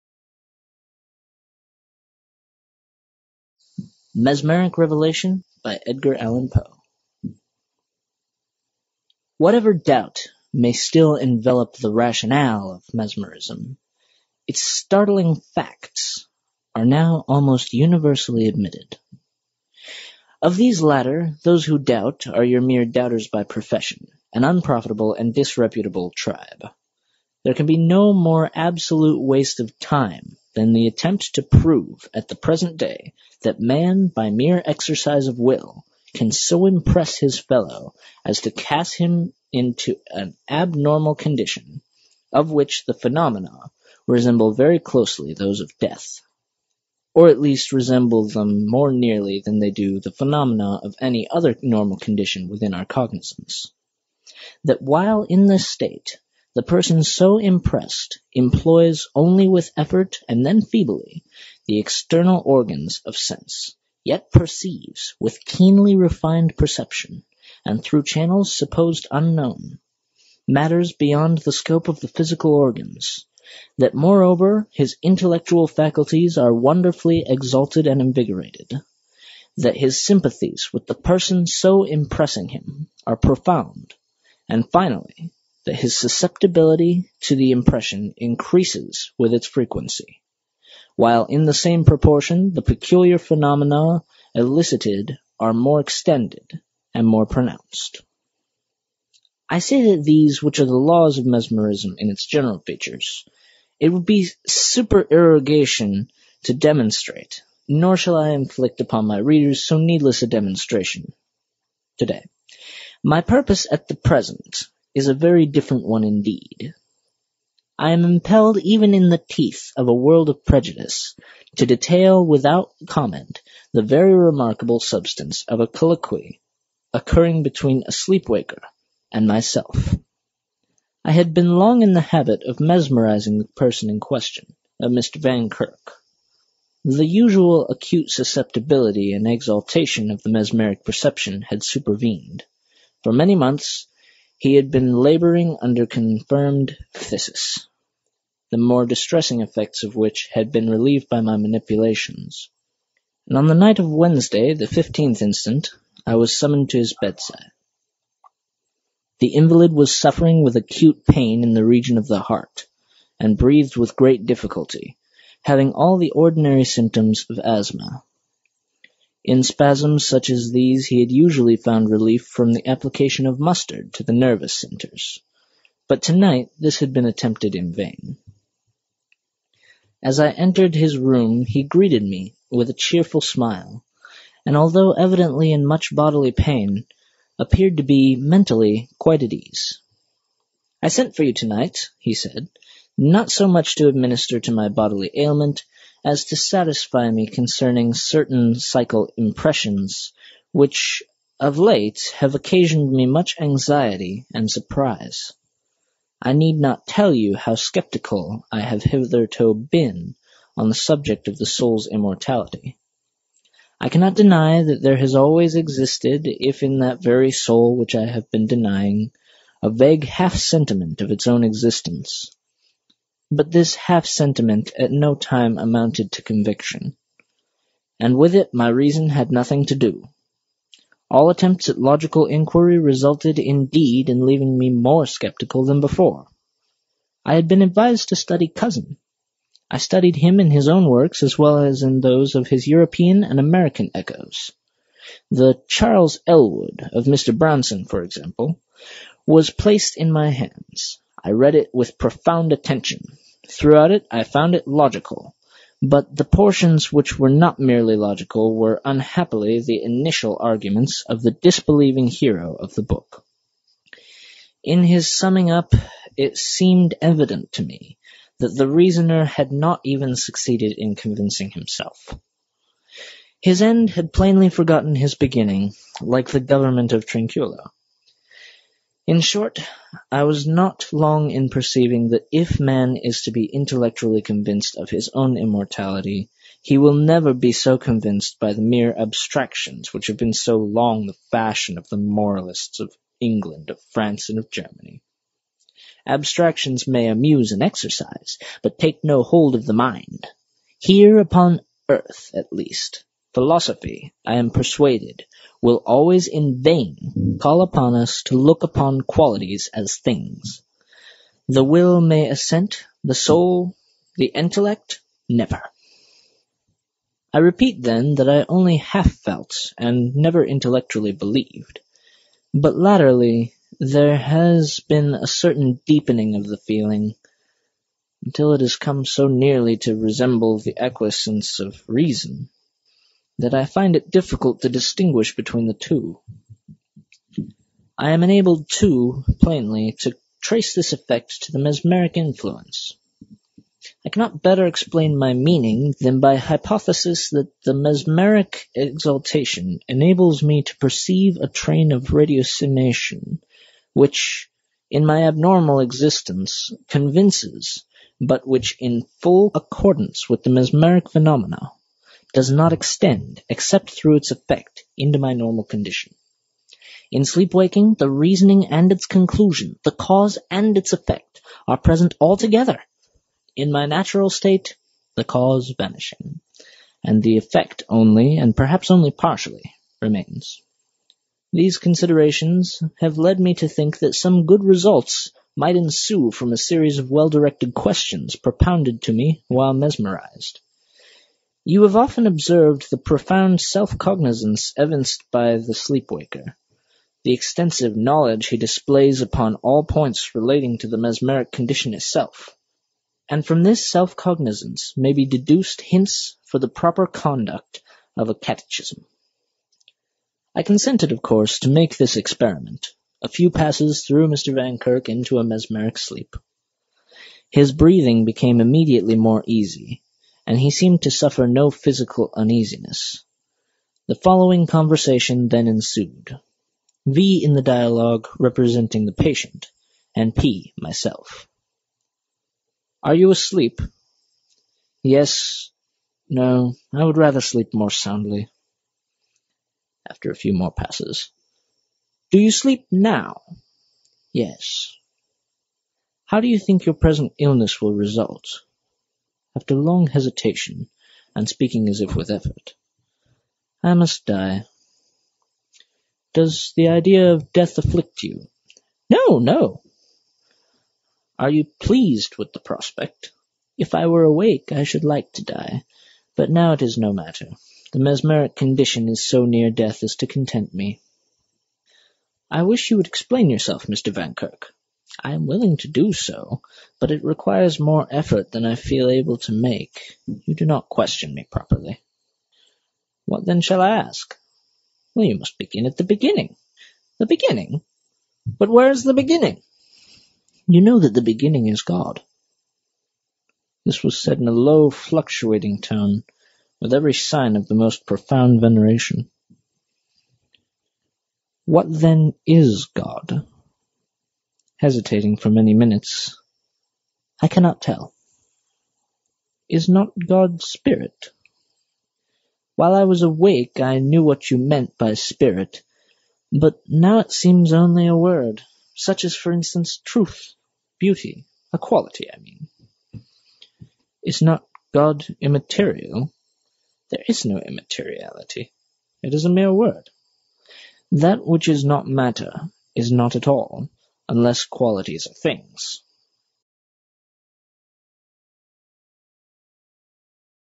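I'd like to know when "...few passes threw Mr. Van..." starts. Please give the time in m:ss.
6:53.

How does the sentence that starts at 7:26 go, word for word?
How do you think your present illness will result?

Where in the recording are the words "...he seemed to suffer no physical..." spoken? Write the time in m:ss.
7:00.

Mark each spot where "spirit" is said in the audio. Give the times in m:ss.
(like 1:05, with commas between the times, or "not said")
8:30, 8:35.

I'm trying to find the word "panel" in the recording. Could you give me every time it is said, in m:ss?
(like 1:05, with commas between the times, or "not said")
not said.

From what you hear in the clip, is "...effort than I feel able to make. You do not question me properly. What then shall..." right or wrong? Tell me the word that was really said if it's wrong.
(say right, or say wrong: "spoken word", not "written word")
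right.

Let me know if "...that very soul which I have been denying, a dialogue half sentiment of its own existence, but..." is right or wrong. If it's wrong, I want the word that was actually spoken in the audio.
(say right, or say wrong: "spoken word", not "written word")
wrong: "vague", not "dialogue".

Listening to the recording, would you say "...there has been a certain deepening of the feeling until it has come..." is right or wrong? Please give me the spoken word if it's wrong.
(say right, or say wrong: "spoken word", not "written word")
right.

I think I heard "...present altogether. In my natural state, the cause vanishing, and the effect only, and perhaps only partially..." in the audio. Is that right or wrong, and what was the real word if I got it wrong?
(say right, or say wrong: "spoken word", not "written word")
right.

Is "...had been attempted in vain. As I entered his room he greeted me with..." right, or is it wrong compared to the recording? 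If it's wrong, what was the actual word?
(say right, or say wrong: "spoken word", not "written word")
right.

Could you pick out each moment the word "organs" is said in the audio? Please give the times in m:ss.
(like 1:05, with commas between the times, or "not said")
1:02, 1:12.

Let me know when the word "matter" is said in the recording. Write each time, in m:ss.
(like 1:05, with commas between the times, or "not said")
1:10, 7:47, 8:52.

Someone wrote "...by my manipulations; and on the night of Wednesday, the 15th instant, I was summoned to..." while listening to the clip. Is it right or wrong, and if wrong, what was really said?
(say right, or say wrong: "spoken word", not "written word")
right.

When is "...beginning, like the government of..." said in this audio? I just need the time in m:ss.
4:35.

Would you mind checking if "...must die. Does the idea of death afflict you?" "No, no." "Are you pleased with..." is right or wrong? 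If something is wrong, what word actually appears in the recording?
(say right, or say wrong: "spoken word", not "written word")
right.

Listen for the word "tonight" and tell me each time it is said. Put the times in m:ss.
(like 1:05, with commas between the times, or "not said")
2:56, 3:11.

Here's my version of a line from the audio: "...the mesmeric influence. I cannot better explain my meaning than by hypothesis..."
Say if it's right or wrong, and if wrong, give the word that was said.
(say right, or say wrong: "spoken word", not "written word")
right.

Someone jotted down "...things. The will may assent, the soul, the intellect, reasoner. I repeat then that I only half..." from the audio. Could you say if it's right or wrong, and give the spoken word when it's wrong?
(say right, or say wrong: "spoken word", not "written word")
wrong: "never", not "reasoner".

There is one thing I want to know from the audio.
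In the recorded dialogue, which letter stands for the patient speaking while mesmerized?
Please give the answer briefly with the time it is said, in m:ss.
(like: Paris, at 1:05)
V, at 7:07.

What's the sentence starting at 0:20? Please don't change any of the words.
Of these latter, those who doubt are your mere doubters by profession, an unprofitable and disreputable tribe.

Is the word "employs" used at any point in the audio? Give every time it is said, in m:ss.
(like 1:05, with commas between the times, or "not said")
0:58.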